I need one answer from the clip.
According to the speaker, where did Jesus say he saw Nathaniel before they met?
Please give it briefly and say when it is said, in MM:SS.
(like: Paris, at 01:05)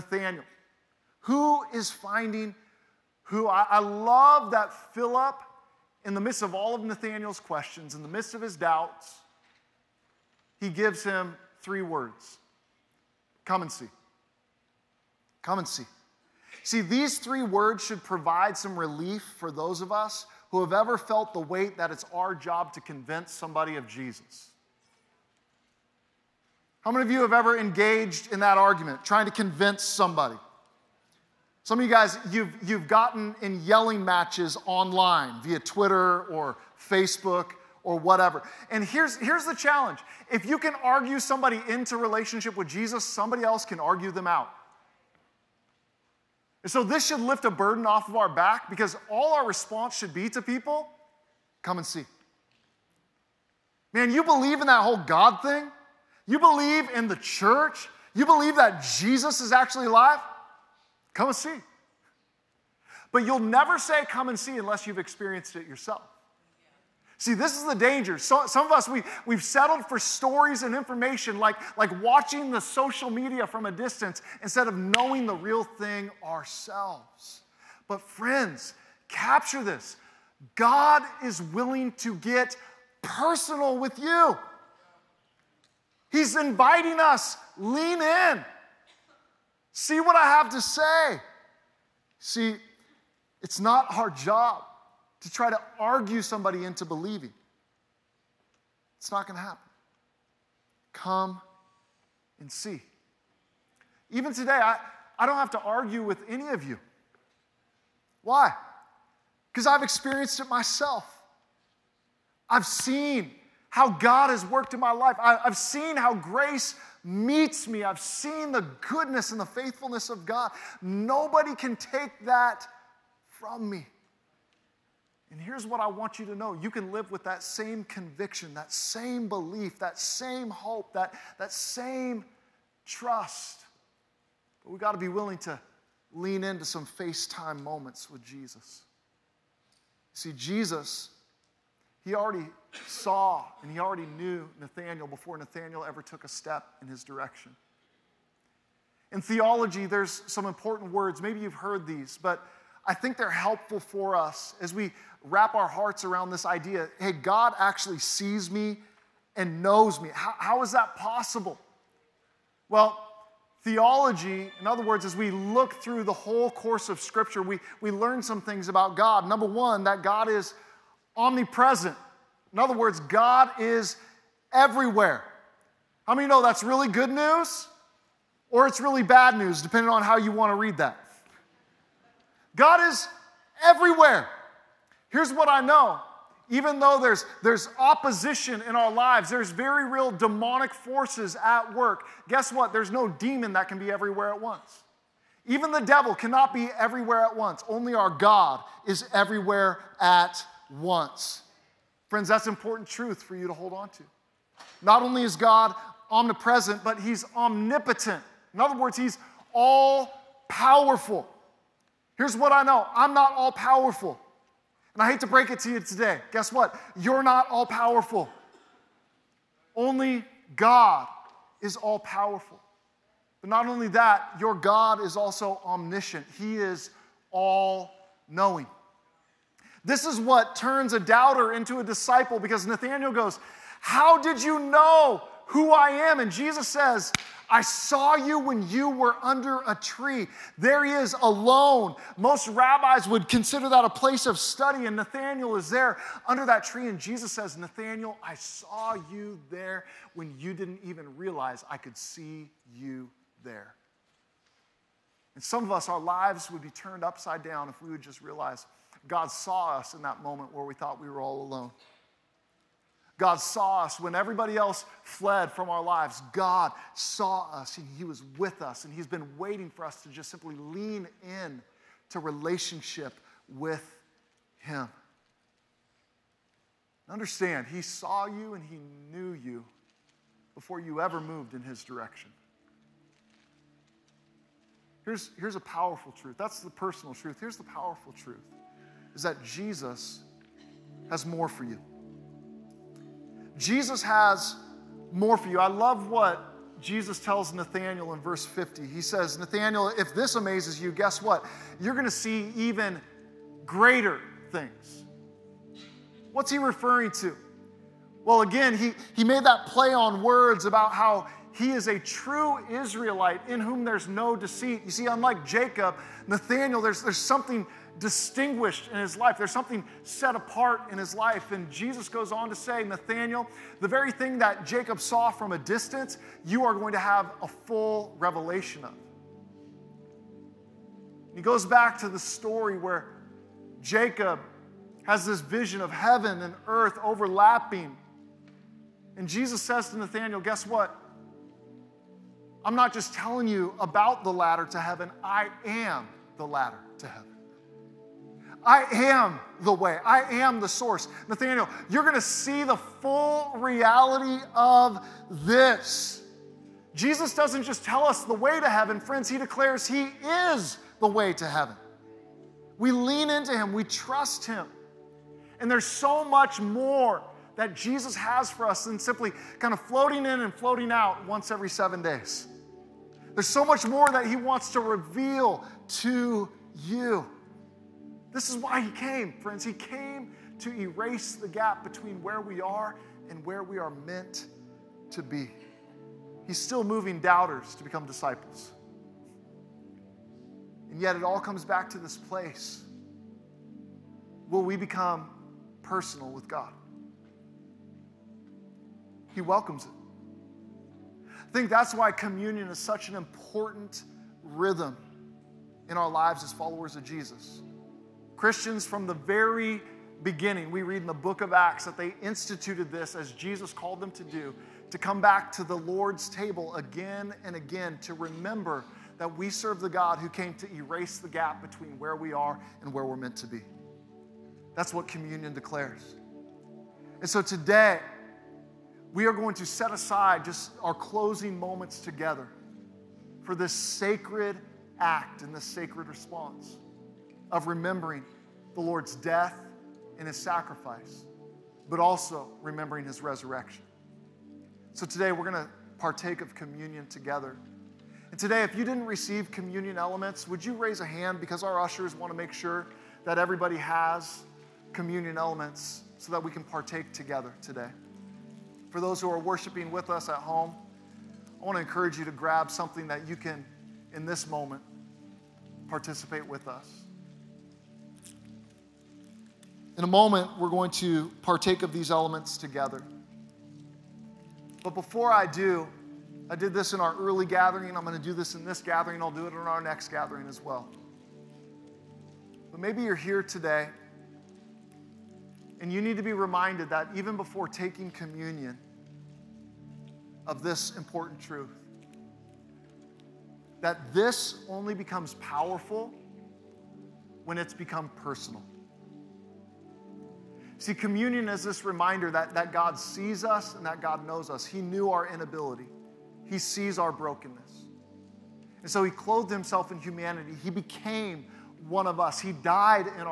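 under a tree, at 03:59.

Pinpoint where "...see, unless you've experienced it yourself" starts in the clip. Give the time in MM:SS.
01:04.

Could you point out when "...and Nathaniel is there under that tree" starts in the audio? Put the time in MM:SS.
04:04.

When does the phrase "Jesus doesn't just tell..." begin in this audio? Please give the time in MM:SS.
05:56.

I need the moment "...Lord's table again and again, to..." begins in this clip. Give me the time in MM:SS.
06:55.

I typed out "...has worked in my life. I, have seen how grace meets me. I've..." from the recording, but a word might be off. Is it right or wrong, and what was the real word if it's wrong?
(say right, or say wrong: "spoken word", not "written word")
right.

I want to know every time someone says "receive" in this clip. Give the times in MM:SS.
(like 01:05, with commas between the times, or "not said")
07:29.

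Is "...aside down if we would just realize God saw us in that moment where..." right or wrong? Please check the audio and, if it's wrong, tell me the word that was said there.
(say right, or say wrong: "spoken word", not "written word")
wrong: "upside", not "aside".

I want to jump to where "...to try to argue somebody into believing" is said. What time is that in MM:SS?
01:35.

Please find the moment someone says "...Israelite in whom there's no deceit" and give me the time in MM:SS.
05:12.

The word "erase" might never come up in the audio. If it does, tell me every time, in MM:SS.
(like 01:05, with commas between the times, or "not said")
06:20, 07:00.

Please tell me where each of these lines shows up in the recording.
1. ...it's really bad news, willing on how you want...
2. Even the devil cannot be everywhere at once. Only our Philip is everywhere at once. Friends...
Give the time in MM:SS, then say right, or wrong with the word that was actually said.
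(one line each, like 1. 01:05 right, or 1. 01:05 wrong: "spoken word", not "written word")
1. 02:58 wrong: "depending", not "willing"
2. 03:15 wrong: "God", not "Philip".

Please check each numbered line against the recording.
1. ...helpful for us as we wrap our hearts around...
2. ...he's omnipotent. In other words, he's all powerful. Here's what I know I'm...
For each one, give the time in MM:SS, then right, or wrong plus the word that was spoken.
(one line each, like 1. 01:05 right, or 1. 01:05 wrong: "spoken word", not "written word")
1. 02:33 right
2. 03:27 right.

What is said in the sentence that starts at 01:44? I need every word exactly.
Even today, I, I don't have to argue with any of you.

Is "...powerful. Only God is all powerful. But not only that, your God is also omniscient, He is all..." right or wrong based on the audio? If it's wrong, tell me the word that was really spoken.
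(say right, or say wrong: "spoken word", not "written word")
right.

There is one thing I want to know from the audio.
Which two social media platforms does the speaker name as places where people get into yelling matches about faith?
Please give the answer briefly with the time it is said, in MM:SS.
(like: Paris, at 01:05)
Twitter or Facebook, at 00:35.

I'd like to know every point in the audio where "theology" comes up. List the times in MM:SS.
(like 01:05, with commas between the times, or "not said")
02:29, 02:43.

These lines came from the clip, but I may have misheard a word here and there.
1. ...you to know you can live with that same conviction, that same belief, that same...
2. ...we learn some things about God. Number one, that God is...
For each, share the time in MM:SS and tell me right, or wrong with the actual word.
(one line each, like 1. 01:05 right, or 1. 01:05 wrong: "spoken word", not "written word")
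1. 02:06 right
2. 02:47 right.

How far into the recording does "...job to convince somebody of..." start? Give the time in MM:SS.
00:22.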